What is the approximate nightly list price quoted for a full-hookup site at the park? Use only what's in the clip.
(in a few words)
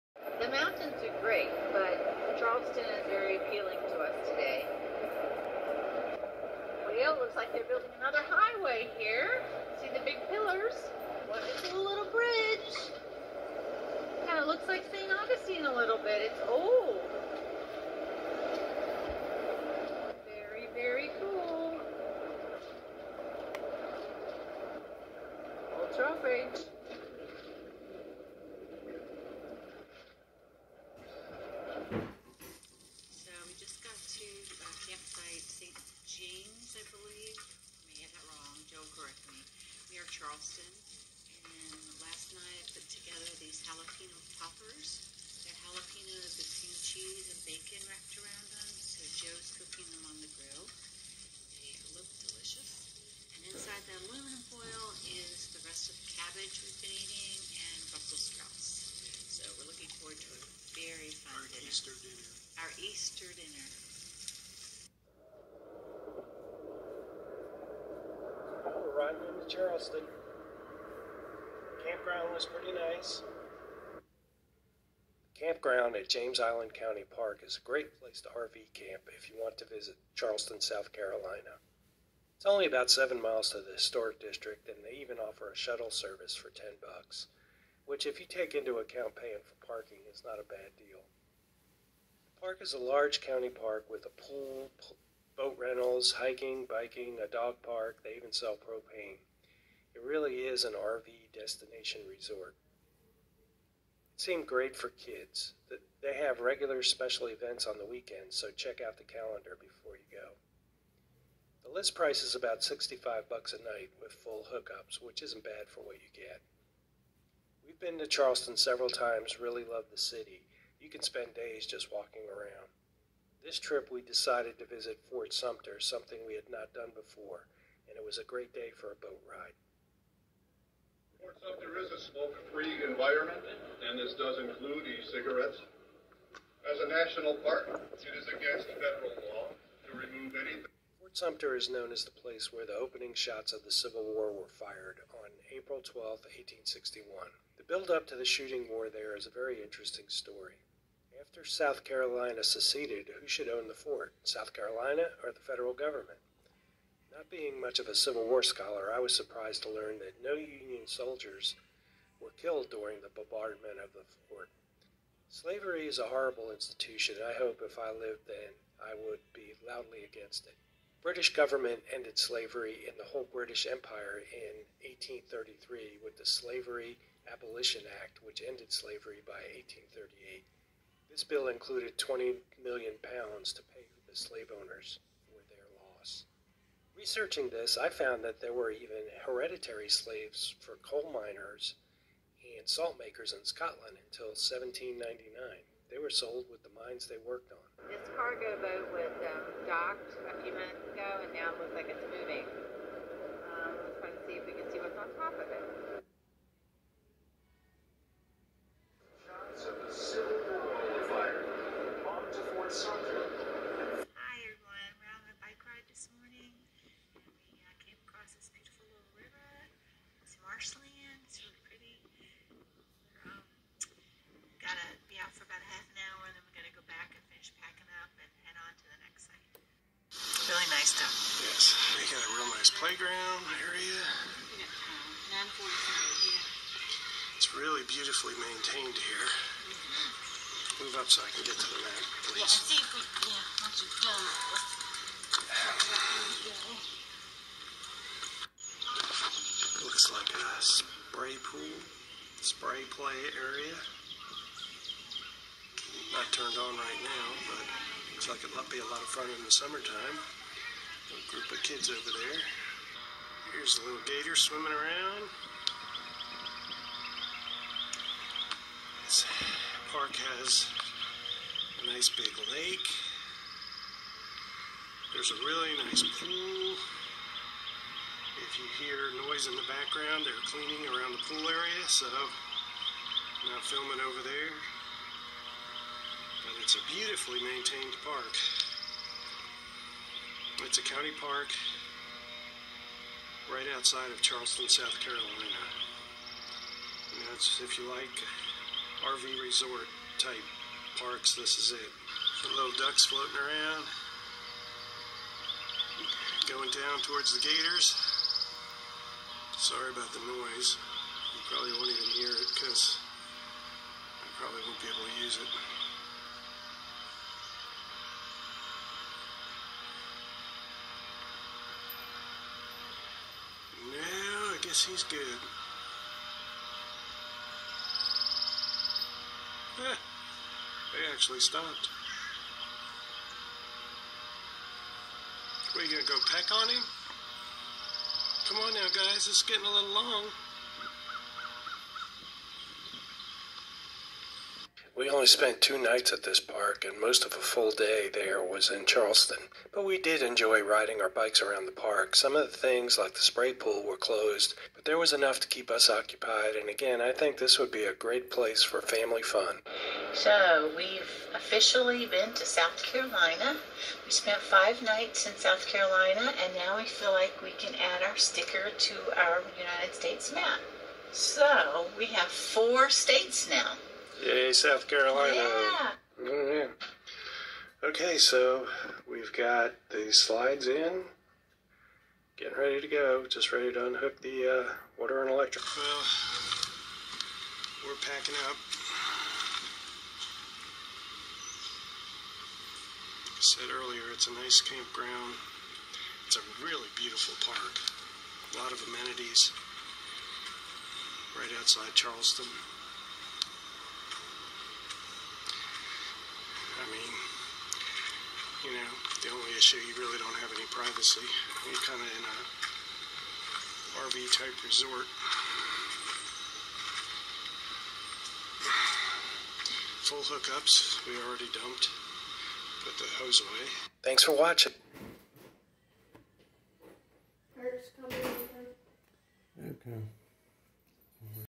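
$65.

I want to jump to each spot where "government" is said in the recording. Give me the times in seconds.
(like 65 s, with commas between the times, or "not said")
155 s, 171 s.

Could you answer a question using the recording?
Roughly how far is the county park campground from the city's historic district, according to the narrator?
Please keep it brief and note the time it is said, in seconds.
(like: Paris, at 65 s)
7 miles, at 82 s.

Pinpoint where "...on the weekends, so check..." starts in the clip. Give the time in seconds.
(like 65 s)
107 s.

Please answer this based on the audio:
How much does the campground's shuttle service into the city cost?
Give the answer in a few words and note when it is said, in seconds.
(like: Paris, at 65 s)
$10, at 86 s.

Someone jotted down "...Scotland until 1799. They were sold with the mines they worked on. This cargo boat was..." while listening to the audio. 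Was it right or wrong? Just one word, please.
right.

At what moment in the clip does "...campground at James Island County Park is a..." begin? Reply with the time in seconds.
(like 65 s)
75 s.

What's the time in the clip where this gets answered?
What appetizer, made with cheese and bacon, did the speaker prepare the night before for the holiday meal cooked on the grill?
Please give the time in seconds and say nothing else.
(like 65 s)
43 s.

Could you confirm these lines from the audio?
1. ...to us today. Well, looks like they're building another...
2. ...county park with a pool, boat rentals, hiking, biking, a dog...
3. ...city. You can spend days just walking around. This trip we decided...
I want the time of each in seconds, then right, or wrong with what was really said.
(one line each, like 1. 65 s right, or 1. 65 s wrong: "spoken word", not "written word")
1. 3 s right
2. 93 s right
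3. 119 s right.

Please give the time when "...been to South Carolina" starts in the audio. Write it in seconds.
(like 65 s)
362 s.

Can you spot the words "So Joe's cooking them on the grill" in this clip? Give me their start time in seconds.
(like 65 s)
48 s.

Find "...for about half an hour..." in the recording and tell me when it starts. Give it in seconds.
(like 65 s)
225 s.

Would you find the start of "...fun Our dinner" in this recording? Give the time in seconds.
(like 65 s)
61 s.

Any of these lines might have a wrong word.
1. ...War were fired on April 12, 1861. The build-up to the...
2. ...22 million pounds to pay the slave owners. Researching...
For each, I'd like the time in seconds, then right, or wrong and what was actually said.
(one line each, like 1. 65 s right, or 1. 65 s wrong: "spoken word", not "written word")
1. 144 s right
2. 181 s wrong: "20", not "22".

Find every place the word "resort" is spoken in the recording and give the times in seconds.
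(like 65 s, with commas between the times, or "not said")
102 s, 299 s, 414 s.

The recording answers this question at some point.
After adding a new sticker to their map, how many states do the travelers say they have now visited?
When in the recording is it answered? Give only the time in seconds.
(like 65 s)
372 s.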